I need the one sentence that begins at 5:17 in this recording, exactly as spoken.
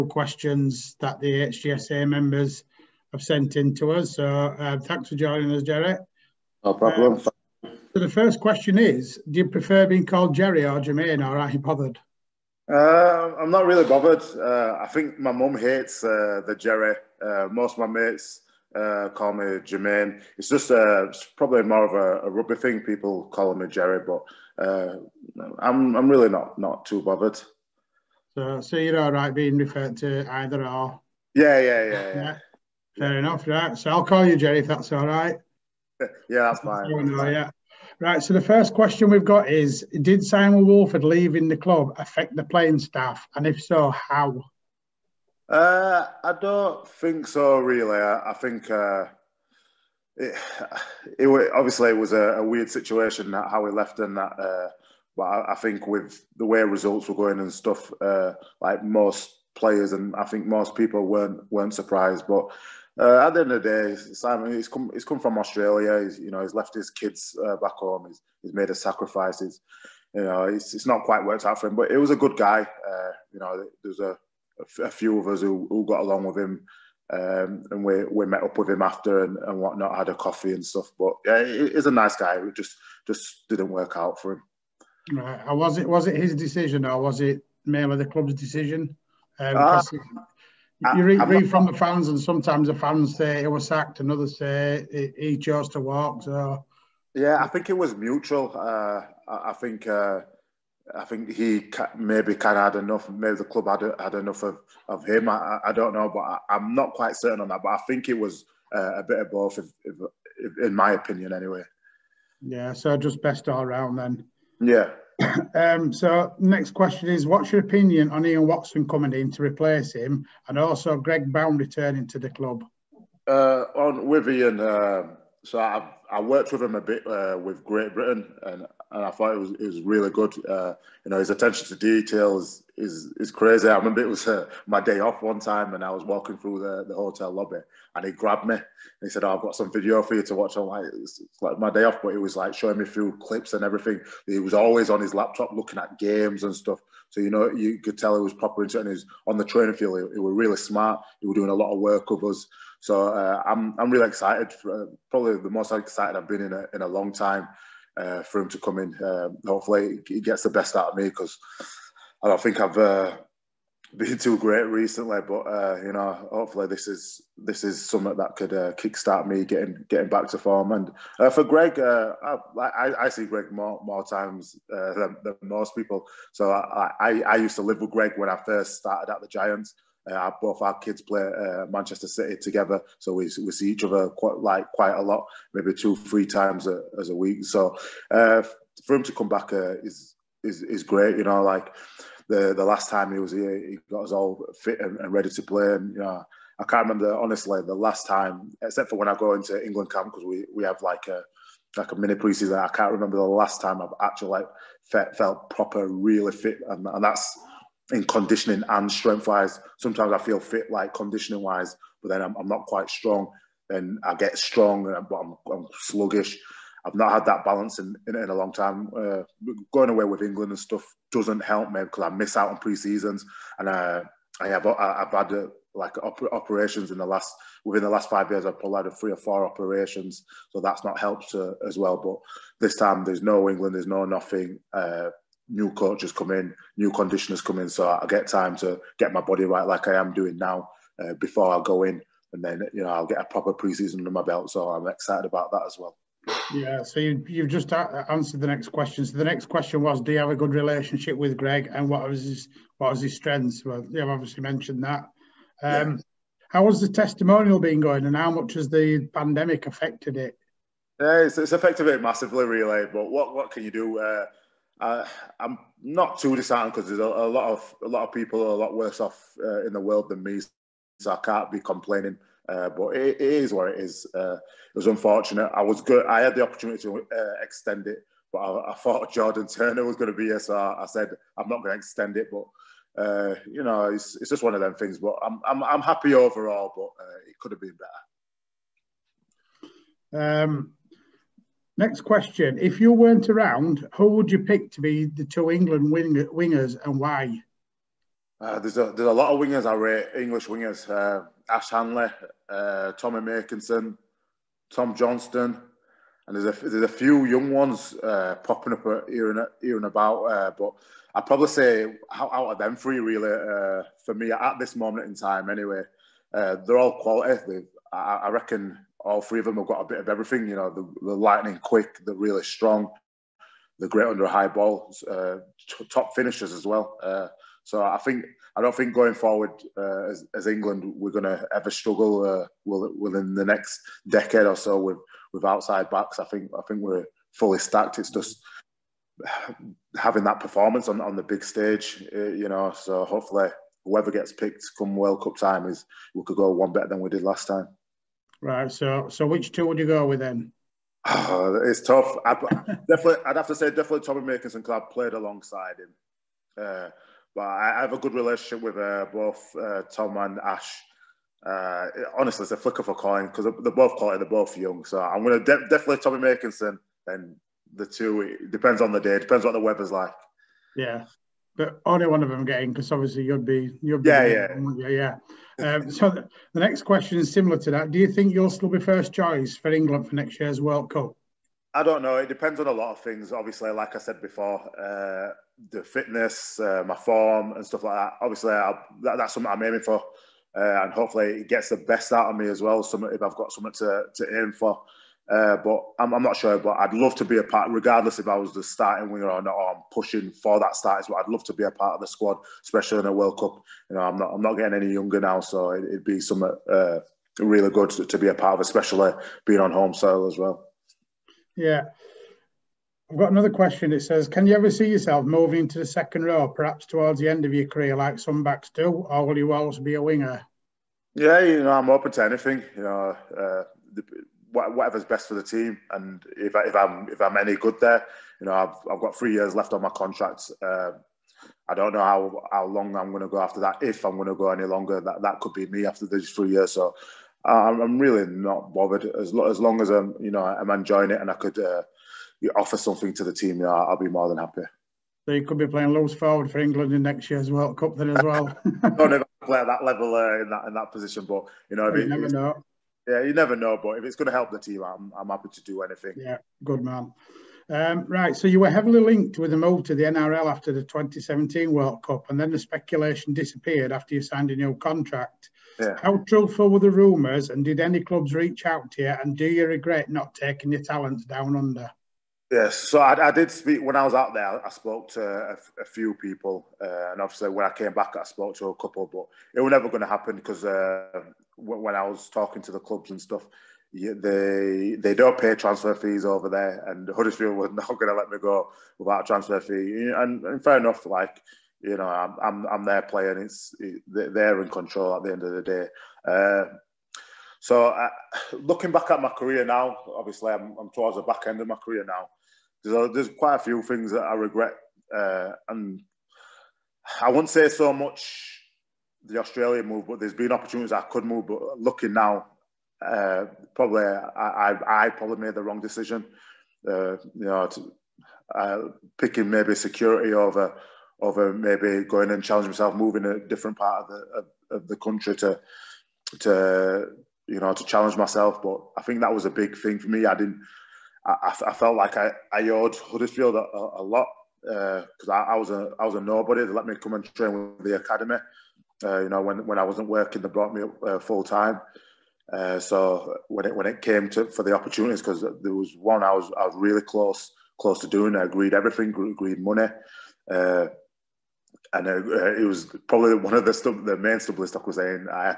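I, I reckon all three of them have got a bit of everything.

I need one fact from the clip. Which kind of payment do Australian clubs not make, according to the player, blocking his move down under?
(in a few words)
Transfer fees.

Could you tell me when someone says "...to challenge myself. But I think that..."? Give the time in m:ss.
8:47.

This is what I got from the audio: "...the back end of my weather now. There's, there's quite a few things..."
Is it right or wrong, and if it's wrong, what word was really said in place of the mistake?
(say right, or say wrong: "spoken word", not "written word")
wrong: "career", not "weather".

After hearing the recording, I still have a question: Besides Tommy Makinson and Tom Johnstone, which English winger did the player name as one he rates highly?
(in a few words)
Ash Handley.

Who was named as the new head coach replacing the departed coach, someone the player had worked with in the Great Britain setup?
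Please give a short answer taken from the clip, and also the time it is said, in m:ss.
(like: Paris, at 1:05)
Ian Watson, at 1:58.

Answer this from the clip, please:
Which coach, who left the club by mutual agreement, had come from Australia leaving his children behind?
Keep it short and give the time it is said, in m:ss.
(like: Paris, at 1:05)
Simon Woolford, at 0:40.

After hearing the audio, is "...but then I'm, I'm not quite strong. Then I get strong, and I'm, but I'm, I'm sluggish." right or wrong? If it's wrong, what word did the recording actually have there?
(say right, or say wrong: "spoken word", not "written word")
right.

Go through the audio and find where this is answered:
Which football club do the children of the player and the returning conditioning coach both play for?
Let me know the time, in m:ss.
3:01.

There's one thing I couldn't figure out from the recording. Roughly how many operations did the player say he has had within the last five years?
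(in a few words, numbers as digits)
3 or 4.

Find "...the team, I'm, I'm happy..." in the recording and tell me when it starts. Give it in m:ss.
7:34.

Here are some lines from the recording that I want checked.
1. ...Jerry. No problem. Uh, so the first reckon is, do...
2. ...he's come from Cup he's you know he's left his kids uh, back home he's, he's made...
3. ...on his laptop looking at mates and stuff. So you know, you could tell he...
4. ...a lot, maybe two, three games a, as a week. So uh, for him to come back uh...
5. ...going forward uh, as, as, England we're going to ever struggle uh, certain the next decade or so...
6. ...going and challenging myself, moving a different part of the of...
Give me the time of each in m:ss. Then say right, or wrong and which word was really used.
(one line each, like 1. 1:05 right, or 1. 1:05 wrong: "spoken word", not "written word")
1. 0:05 wrong: "question", not "reckon"
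2. 1:04 wrong: "Australia", not "Cup"
3. 2:24 wrong: "games", not "mates"
4. 3:04 wrong: "times", not "games"
5. 5:28 wrong: "within", not "certain"
6. 8:42 right.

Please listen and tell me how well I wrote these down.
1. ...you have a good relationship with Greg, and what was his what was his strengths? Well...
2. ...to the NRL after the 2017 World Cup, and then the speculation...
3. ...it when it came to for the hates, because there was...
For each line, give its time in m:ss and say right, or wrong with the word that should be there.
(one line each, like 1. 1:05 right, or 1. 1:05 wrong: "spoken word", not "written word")
1. 4:10 right
2. 7:39 right
3. 9:03 wrong: "opportunities", not "hates".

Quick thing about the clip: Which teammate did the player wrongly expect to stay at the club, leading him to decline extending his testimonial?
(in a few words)
Jordan Turner.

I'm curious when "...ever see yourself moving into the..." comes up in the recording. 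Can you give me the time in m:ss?
6:54.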